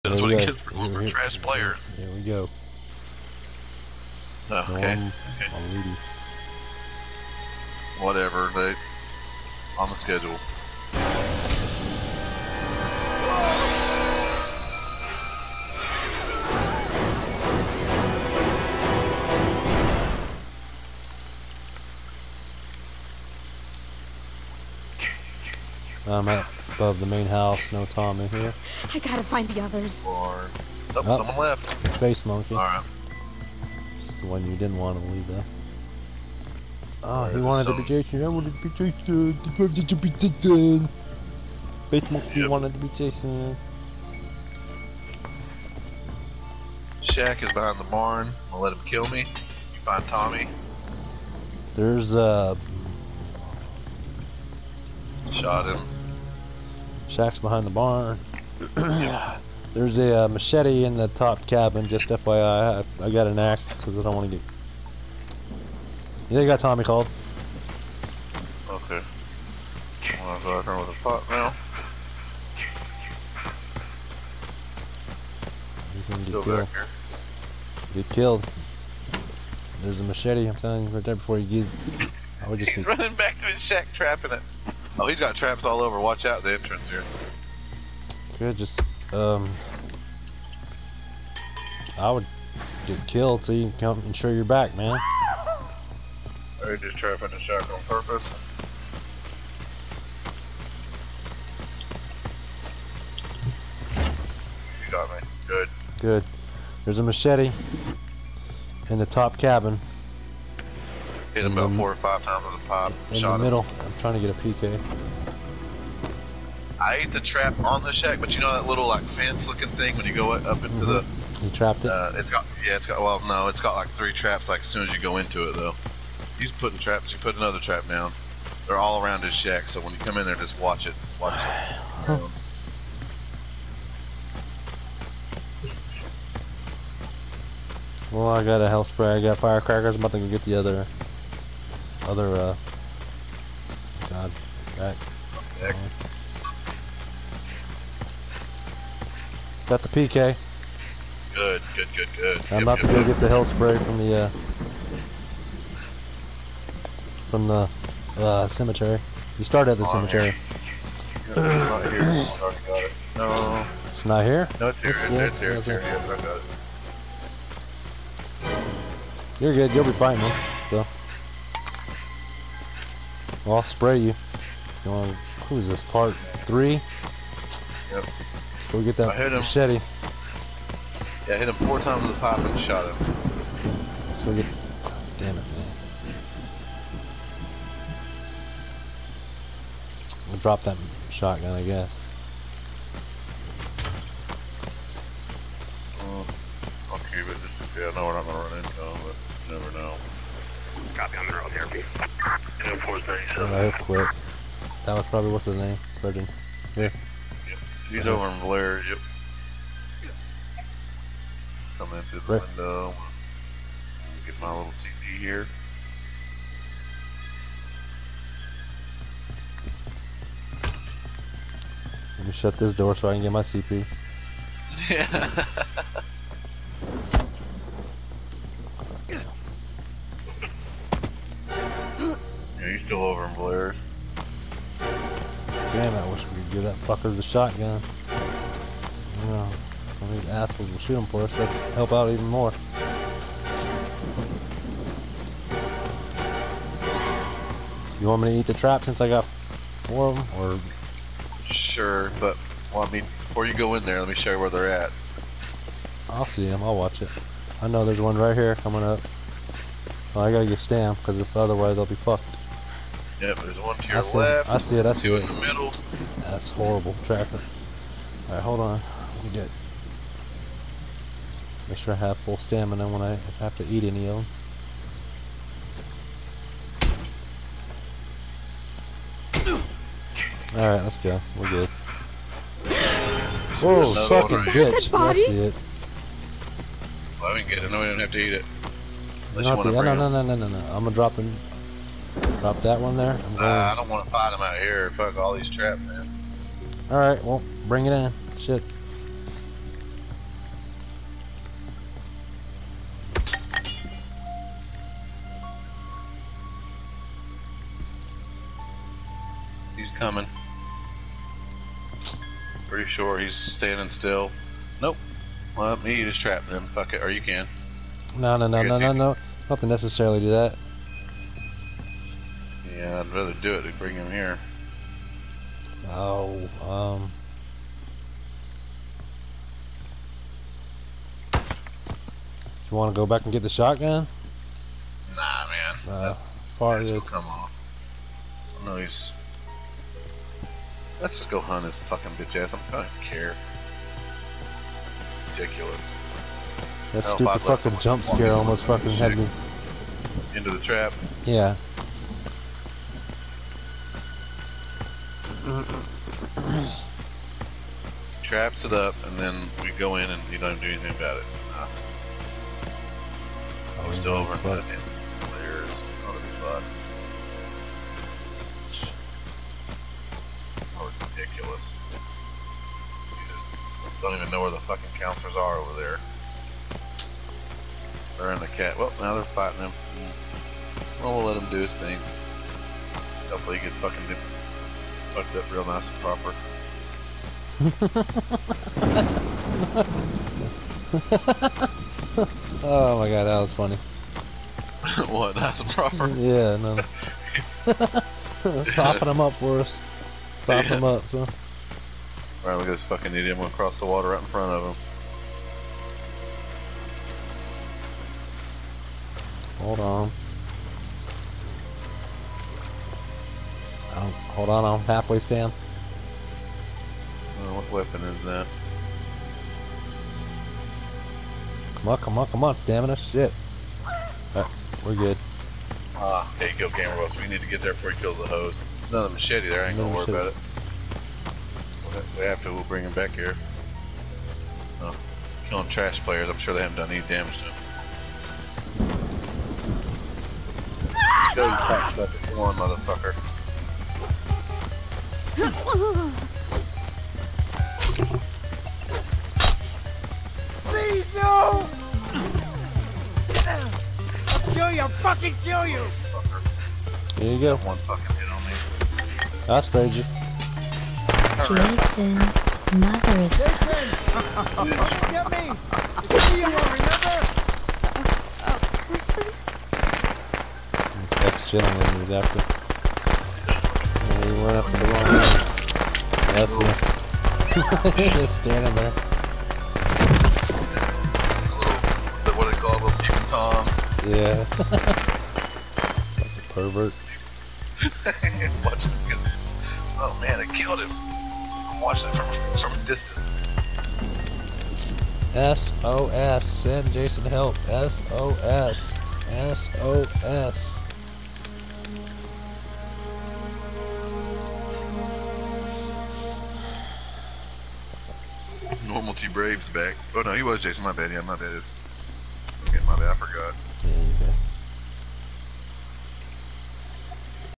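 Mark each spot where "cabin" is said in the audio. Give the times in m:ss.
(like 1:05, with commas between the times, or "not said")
1:01, 1:49.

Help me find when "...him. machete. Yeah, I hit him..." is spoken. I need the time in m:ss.
2:59.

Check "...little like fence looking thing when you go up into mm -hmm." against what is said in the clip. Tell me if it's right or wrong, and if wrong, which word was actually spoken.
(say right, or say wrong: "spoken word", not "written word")
right.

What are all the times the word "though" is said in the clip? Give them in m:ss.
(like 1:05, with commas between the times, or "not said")
2:05.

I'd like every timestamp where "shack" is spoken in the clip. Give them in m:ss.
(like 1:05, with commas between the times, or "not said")
0:47, 0:57, 1:23, 1:57, 2:09.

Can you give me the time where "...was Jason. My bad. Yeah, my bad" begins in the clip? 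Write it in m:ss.
8:30.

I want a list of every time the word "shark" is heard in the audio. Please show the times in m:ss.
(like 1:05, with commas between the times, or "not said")
1:37.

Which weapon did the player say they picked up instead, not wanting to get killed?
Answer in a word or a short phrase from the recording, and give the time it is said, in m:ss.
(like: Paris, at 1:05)
An axe, at 1:03.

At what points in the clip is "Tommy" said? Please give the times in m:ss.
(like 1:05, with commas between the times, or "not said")
0:50, 1:06.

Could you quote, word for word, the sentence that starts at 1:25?
Oh, he's got traps all over.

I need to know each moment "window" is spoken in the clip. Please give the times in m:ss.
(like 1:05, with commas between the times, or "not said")
3:32.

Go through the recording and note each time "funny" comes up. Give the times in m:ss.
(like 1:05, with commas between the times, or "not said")
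6:33.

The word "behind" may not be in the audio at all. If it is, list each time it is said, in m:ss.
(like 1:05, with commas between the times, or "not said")
0:47, 0:57.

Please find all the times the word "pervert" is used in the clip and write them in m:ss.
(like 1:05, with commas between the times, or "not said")
8:06.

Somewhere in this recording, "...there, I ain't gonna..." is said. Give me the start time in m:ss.
7:09.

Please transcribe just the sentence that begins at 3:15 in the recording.
Uh, I'll keep it just yeah, I know we're not gonna run into him, but never know.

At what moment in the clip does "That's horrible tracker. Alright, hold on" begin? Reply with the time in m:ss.
4:26.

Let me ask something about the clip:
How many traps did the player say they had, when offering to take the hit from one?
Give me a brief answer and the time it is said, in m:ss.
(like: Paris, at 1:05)
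4, at 4:09.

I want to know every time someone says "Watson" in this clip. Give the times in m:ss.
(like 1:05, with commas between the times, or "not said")
not said.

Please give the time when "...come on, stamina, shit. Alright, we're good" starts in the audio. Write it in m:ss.
7:02.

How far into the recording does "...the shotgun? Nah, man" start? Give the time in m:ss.
5:33.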